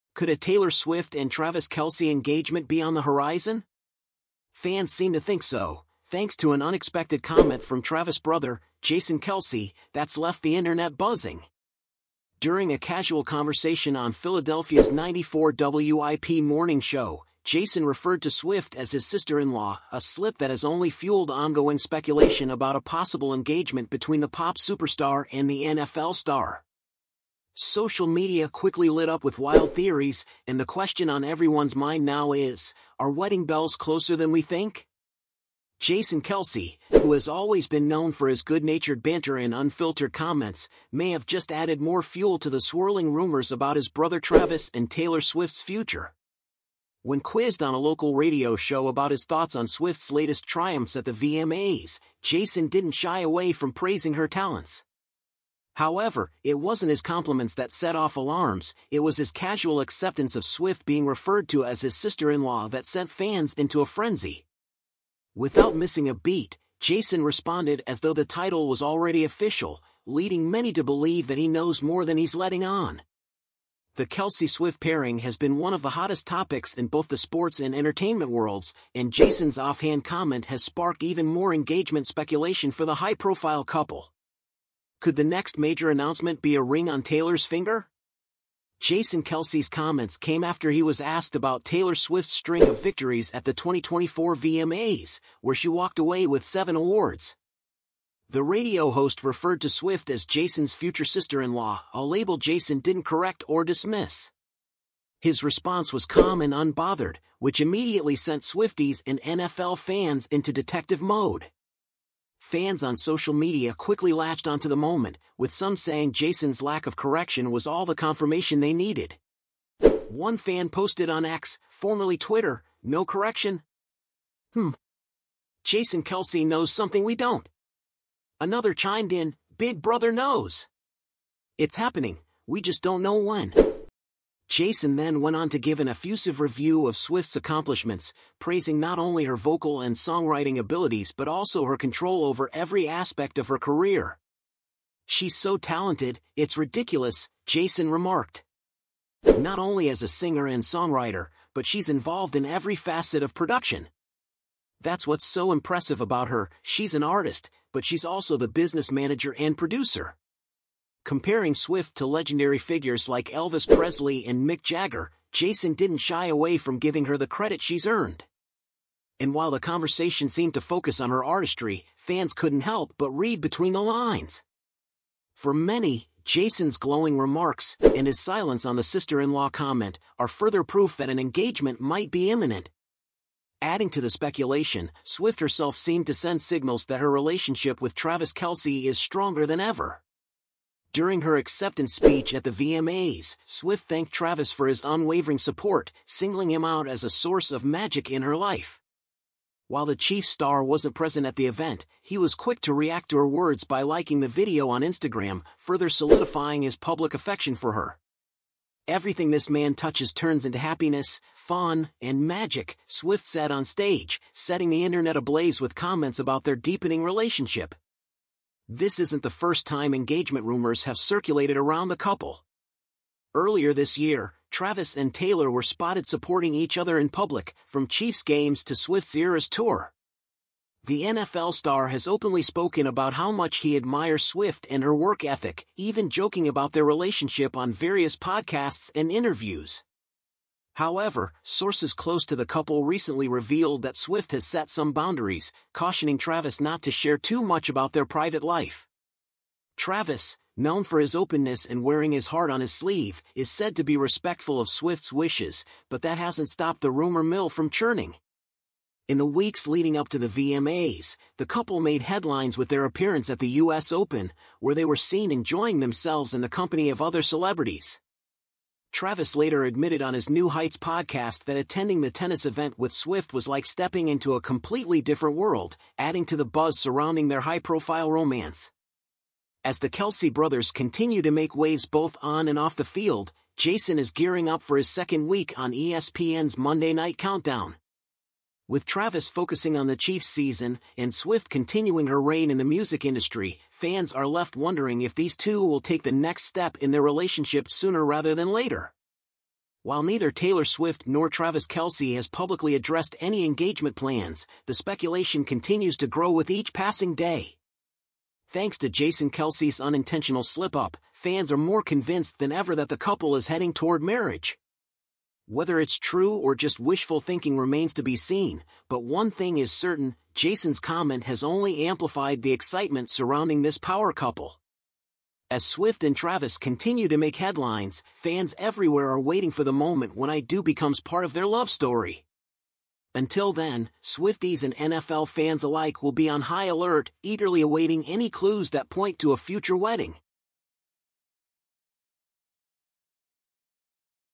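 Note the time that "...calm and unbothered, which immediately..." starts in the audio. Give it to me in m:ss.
1:46.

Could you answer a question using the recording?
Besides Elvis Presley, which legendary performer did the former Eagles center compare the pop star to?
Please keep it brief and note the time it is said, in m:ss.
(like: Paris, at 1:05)
Mick Jagger, at 2:44.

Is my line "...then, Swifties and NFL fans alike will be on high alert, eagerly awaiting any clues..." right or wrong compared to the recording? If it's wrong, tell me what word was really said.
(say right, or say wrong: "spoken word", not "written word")
right.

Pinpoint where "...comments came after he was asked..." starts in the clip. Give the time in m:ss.
1:29.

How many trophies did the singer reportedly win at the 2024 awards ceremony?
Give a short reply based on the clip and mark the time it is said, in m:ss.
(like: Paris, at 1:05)
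7, at 1:36.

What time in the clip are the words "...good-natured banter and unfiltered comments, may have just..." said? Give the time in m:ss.
0:38.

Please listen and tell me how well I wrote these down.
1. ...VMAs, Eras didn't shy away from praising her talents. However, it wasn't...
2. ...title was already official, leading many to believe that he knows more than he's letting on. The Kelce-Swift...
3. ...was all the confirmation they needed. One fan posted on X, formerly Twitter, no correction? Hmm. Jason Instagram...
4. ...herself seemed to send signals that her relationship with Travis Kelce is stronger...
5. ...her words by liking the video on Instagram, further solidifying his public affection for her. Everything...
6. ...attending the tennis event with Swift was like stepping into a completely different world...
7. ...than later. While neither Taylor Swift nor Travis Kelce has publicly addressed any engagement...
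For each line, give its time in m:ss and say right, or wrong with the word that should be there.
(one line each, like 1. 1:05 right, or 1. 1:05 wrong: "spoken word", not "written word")
1. 0:51 wrong: "Jason", not "Eras"
2. 1:08 right
3. 1:57 wrong: "Kelce", not "Instagram"
4. 3:05 right
5. 3:23 right
6. 4:31 right
7. 4:58 right.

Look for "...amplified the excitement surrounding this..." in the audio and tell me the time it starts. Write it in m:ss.
5:21.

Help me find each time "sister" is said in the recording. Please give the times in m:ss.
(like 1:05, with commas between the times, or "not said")
0:19, 1:01, 1:41, 2:58.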